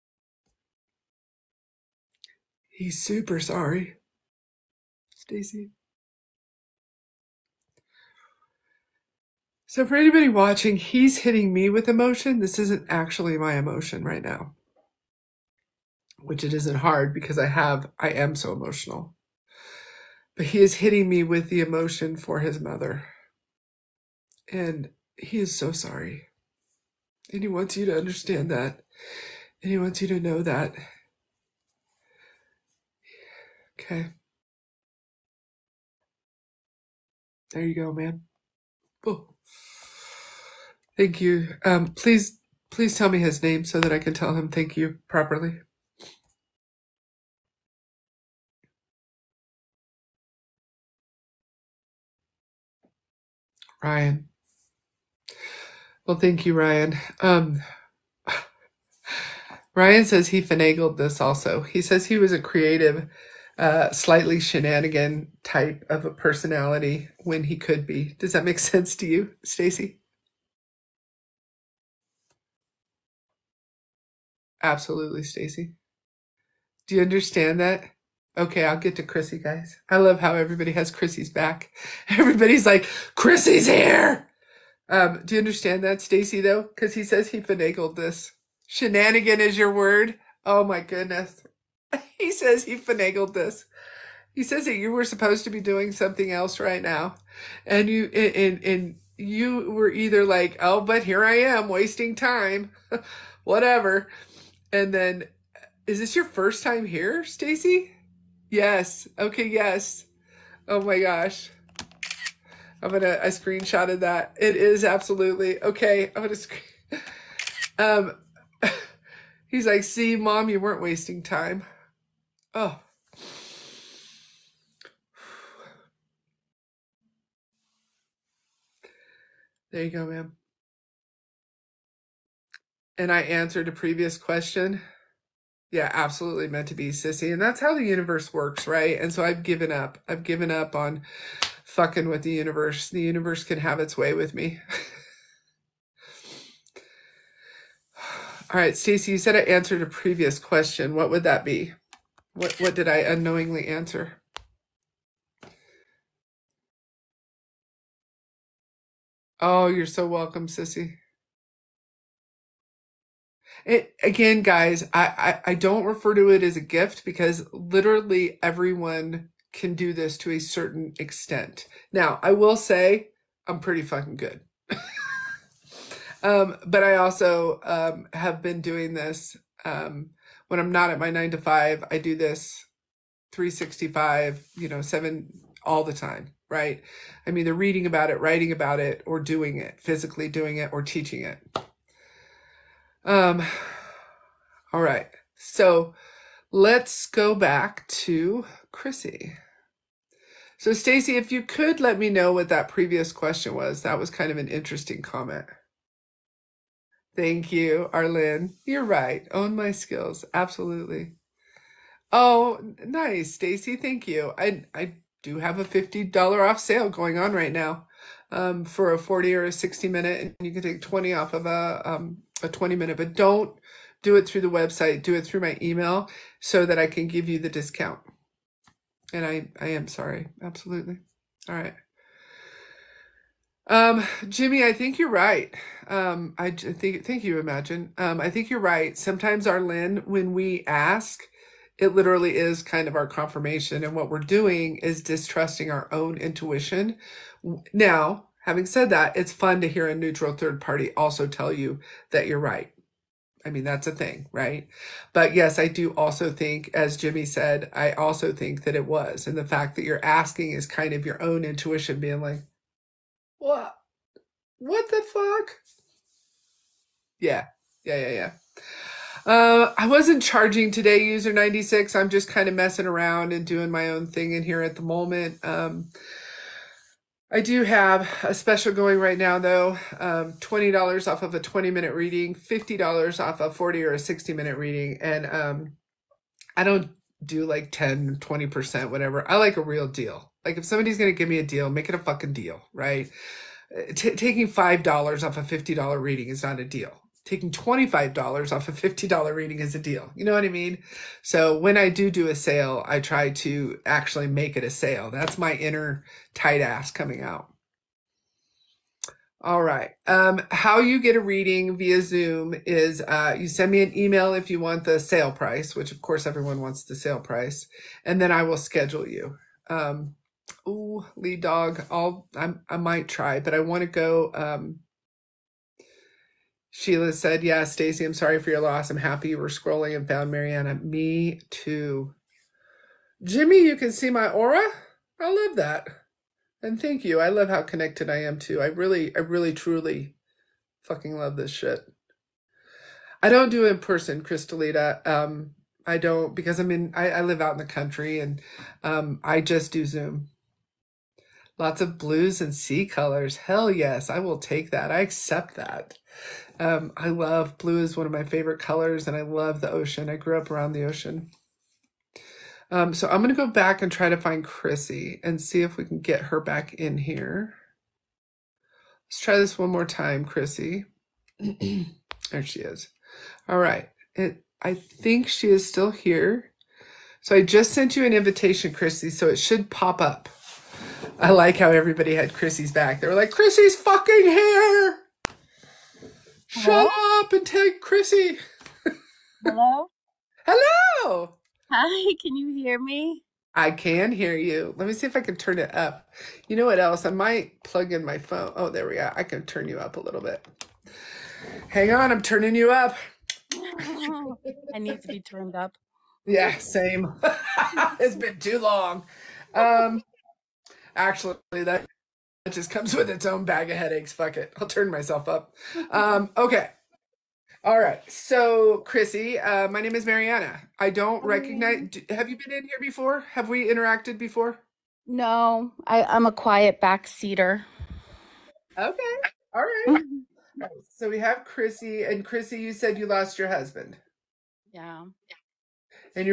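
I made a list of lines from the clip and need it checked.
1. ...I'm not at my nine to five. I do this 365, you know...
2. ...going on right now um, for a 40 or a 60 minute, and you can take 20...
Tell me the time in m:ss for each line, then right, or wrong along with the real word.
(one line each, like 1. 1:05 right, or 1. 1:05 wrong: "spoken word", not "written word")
1. 3:00 right
2. 3:36 right.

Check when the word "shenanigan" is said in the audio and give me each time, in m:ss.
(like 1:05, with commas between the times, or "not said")
1:04, 1:28.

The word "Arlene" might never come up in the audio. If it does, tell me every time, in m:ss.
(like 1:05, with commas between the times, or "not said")
3:27, 3:59.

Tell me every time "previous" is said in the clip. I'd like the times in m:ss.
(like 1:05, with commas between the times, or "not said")
2:13, 2:29, 3:22.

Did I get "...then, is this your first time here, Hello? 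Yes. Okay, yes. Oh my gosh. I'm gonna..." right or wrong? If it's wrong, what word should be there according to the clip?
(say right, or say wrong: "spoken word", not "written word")
wrong: "Stacey", not "Hello".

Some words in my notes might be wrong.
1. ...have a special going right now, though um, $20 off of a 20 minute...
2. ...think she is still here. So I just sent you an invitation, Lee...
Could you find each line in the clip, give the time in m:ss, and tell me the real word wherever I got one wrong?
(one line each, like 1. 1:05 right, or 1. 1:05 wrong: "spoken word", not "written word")
1. 4:37 right
2. 6:14 wrong: "Chrissy", not "Lee".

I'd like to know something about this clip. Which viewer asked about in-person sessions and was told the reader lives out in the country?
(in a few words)
Crystalita.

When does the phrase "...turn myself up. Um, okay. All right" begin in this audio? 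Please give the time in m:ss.
6:54.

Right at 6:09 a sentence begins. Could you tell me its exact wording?
Let's try this one more time, Chrissy.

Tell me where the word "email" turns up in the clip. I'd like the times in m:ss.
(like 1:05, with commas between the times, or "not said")
3:45, 5:13.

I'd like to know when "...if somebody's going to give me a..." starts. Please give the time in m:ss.
4:50.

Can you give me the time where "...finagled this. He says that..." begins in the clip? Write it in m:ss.
1:32.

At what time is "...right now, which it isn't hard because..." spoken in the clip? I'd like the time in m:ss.
0:14.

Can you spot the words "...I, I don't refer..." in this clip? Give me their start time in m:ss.
2:45.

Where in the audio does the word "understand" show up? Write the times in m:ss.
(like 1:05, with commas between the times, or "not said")
0:27, 1:17, 1:25.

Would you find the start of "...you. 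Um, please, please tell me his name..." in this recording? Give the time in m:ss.
0:41.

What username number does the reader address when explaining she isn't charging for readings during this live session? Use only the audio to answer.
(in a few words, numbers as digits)
96.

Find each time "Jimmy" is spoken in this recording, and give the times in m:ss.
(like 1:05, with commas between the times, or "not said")
3:54, 4:16, 5:33.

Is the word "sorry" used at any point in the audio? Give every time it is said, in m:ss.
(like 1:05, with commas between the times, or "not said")
0:03, 0:25, 3:49, 5:28.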